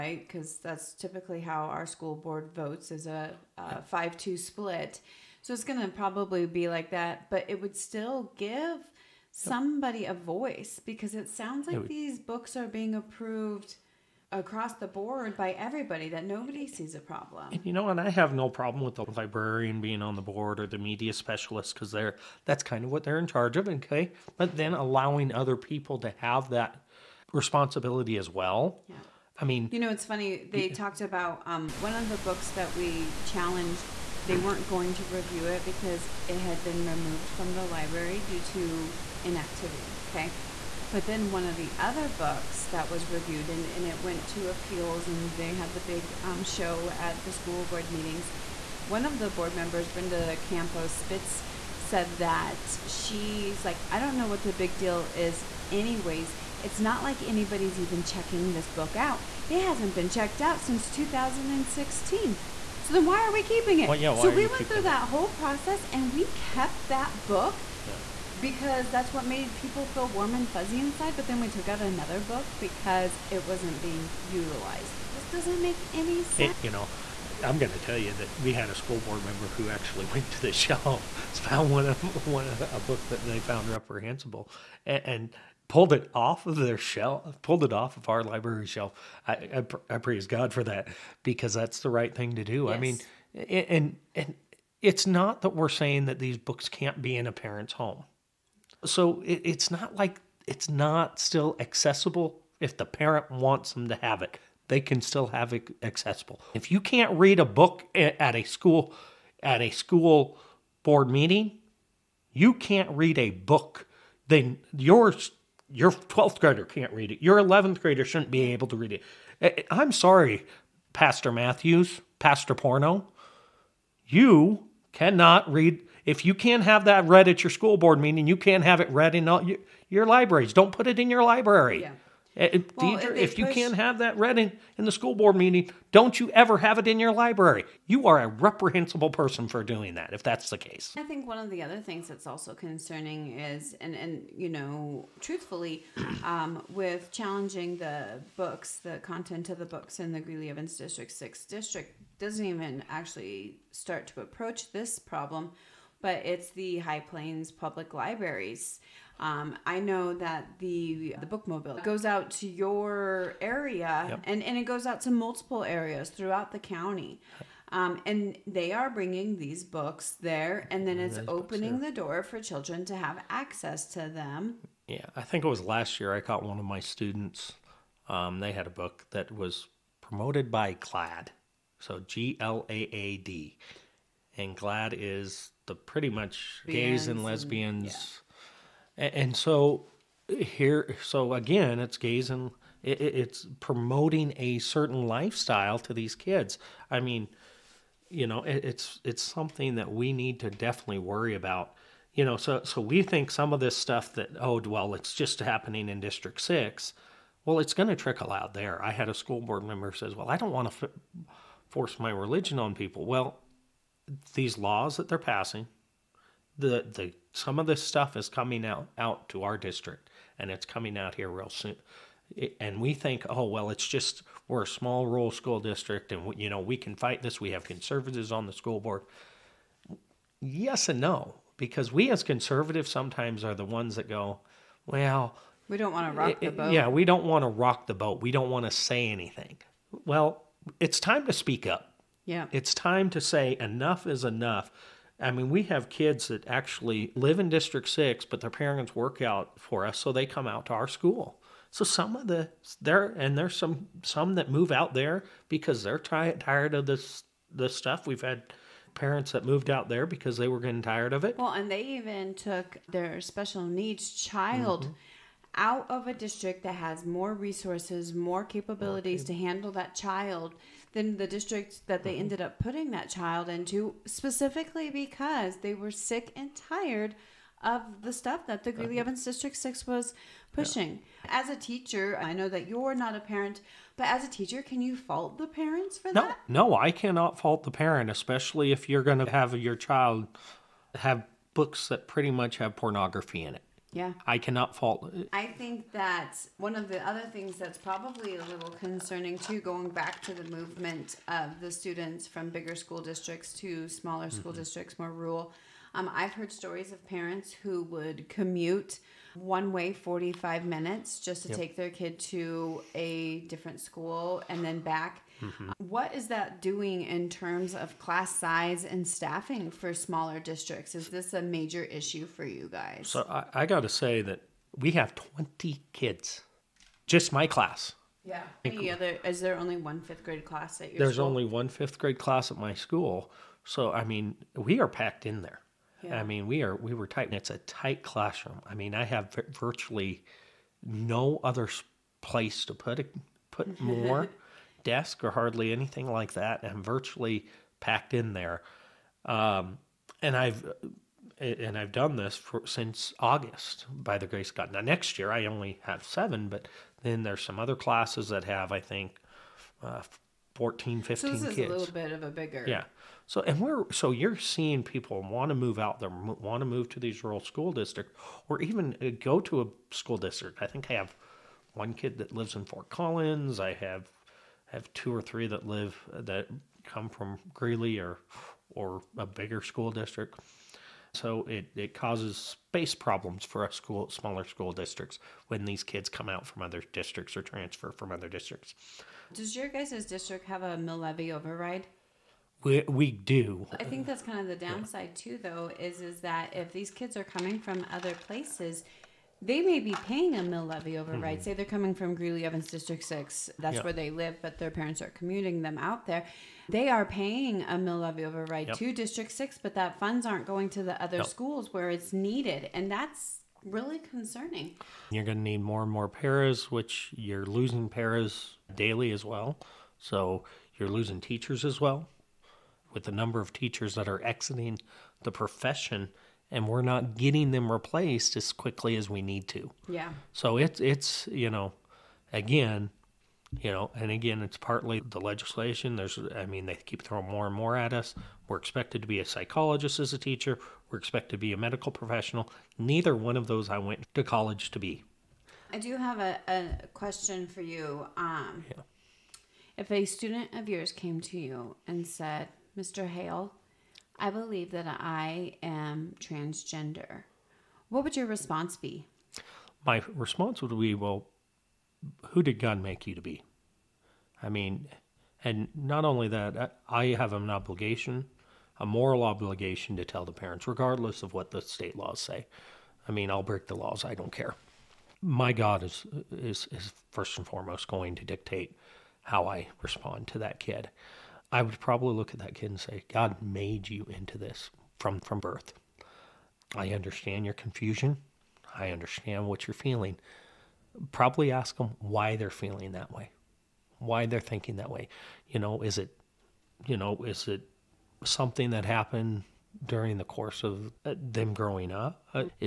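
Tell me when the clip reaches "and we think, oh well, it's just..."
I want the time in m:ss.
3:42.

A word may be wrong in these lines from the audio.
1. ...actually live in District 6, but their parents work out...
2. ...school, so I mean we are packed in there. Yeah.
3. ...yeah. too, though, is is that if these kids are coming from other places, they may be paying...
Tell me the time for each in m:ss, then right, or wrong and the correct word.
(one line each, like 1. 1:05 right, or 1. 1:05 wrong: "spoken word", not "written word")
1. 4:06 right
2. 5:32 right
3. 6:35 right.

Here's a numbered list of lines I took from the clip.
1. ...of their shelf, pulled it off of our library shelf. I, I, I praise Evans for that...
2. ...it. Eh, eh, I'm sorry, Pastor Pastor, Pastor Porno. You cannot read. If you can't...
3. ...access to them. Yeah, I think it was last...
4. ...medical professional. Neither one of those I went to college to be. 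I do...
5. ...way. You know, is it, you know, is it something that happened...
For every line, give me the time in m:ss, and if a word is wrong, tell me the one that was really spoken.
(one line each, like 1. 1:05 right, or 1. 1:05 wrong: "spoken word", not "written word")
1. 1:26 wrong: "God", not "Evans"
2. 1:58 wrong: "Matthews", not "Pastor"
3. 2:53 right
4. 7:21 right
5. 8:14 right.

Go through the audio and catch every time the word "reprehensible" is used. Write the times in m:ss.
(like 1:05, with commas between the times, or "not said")
1:23, 2:18.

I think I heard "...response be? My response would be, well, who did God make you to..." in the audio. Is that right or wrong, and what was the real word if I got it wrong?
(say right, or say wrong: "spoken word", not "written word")
right.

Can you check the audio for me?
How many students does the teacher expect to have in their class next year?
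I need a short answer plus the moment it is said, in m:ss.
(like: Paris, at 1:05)
7, at 5:56.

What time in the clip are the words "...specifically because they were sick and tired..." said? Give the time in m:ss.
4:34.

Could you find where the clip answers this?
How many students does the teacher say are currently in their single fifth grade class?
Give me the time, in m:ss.
5:25.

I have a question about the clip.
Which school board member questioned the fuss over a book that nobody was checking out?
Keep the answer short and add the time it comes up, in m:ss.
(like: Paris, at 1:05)
Brenda Campo Spitz, at 0:49.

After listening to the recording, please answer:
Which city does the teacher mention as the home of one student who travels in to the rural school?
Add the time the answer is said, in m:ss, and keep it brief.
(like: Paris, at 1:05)
Fort Collins, at 6:12.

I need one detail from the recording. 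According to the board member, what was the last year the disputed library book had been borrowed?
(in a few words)
2016.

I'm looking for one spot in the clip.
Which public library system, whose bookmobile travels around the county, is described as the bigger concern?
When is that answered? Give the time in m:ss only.
2:36.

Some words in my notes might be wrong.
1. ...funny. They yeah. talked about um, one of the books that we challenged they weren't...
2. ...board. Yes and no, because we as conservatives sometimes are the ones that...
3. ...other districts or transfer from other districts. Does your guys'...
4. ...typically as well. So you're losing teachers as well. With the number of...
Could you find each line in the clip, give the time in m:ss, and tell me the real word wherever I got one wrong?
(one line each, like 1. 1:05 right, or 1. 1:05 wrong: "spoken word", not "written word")
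1. 0:30 right
2. 3:48 right
3. 6:26 right
4. 6:58 wrong: "daily", not "typically".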